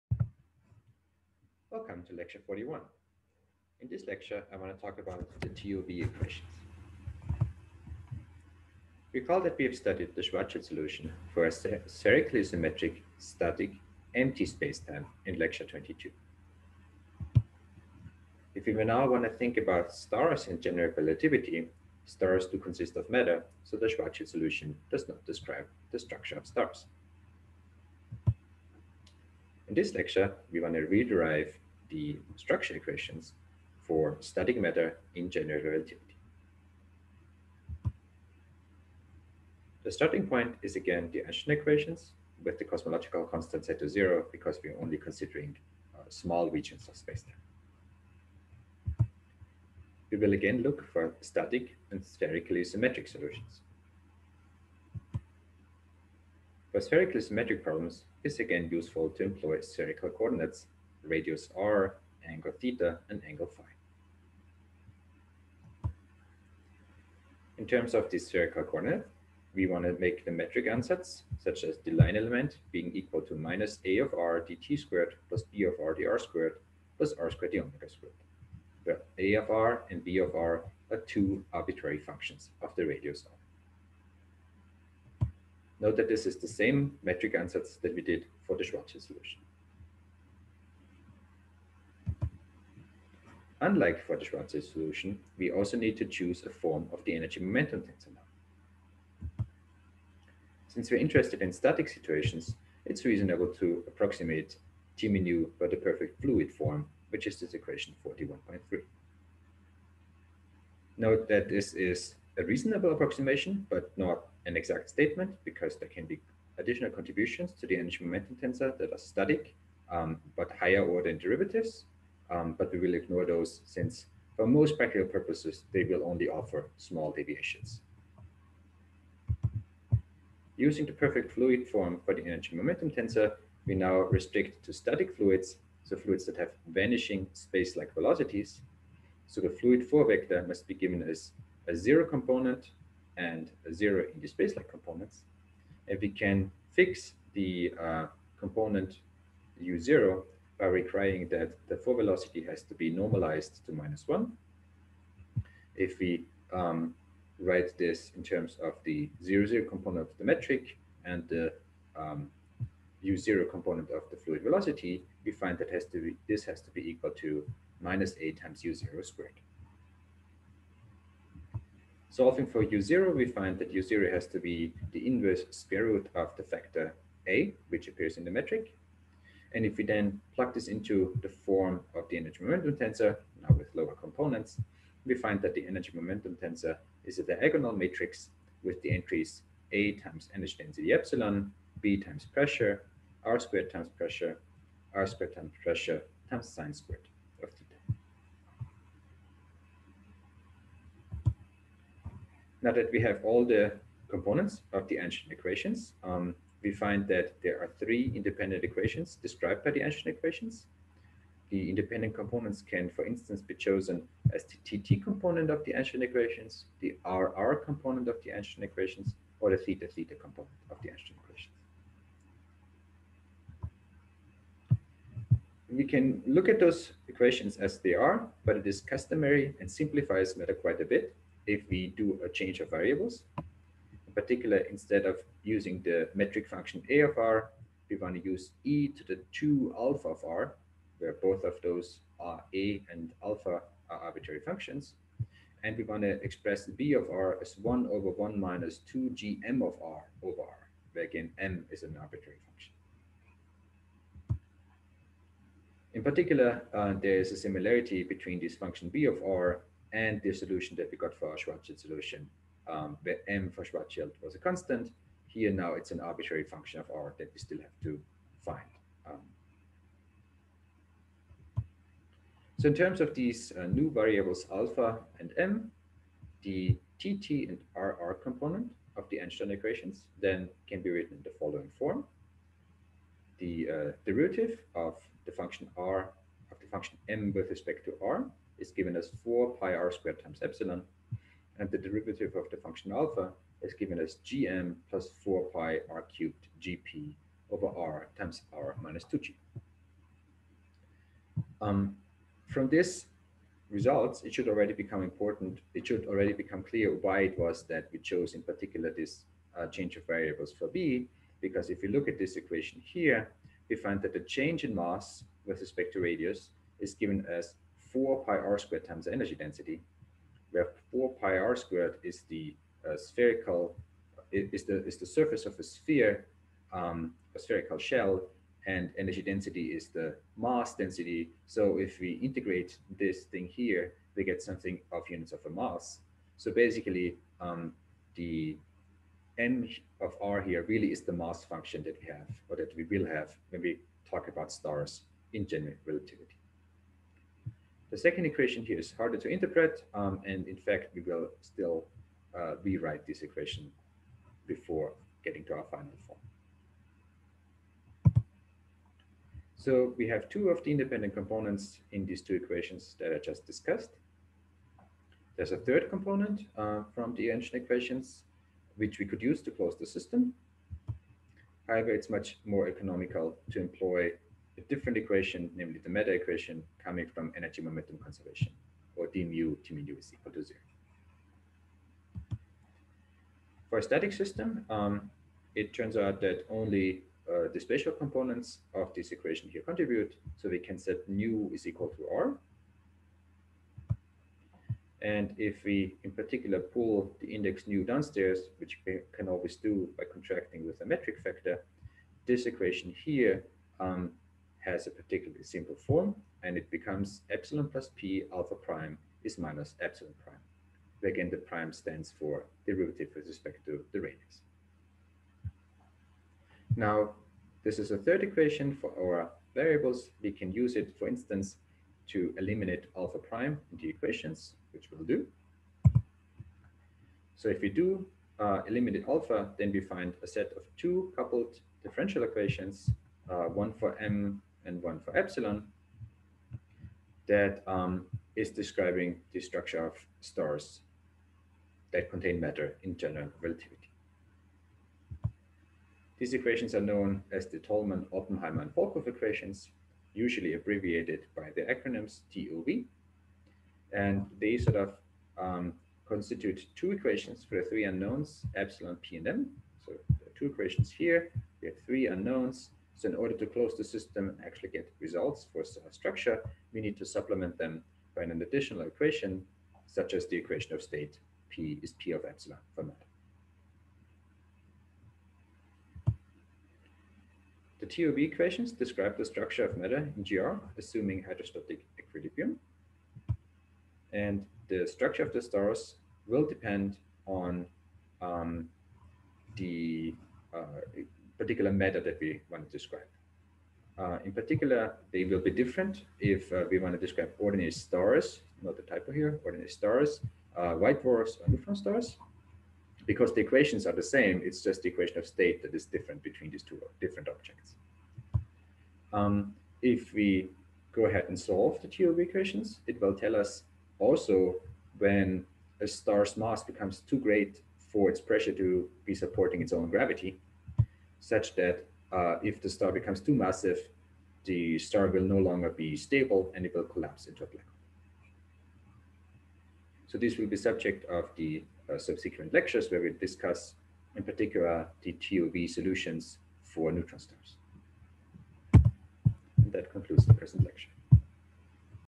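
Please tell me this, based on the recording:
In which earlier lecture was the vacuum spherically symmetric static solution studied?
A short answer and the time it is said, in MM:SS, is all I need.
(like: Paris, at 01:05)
22, at 00:15.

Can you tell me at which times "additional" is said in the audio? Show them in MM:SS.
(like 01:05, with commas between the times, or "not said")
01:56, 07:48.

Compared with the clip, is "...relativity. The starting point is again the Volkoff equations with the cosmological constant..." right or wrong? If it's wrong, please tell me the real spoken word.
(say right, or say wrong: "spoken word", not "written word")
wrong: "Einstein", not "Volkoff".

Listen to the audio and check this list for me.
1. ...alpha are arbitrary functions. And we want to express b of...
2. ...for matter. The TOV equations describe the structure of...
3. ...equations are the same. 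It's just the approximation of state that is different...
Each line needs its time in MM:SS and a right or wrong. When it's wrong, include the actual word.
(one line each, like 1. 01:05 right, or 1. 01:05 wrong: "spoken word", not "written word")
1. 04:03 right
2. 07:52 right
3. 08:23 wrong: "equation", not "approximation".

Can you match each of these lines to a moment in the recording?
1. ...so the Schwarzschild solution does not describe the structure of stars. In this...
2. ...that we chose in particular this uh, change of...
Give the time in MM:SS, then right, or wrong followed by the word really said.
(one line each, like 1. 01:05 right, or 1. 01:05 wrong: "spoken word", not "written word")
1. 00:23 right
2. 05:07 right.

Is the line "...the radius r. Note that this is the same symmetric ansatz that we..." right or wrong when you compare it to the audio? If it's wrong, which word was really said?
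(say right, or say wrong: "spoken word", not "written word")
wrong: "metric", not "symmetric".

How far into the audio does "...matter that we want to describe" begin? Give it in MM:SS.
08:11.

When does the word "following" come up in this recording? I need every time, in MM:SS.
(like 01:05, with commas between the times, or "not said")
04:41.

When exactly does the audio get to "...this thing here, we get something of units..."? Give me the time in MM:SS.
05:32.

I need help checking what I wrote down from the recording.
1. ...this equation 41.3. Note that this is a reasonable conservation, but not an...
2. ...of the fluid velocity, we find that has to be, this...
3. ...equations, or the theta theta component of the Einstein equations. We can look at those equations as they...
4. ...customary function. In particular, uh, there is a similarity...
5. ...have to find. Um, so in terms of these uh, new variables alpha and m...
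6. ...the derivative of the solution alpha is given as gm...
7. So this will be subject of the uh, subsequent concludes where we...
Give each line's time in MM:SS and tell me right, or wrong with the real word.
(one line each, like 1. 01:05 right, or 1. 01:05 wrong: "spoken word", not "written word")
1. 01:47 wrong: "approximation", not "conservation"
2. 02:43 right
3. 03:38 right
4. 04:11 wrong: "arbitrary", not "customary"
5. 04:27 right
6. 04:51 wrong: "function", not "solution"
7. 08:50 wrong: "lectures", not "concludes".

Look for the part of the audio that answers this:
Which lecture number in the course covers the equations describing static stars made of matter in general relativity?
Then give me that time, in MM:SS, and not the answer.
00:02.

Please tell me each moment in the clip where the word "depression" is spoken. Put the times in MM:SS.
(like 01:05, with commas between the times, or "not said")
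not said.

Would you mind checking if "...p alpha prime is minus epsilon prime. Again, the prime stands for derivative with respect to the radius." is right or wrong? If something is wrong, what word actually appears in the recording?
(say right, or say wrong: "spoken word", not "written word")
right.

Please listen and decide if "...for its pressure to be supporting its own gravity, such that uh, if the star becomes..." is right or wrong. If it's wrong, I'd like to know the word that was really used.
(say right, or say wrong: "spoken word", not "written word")
right.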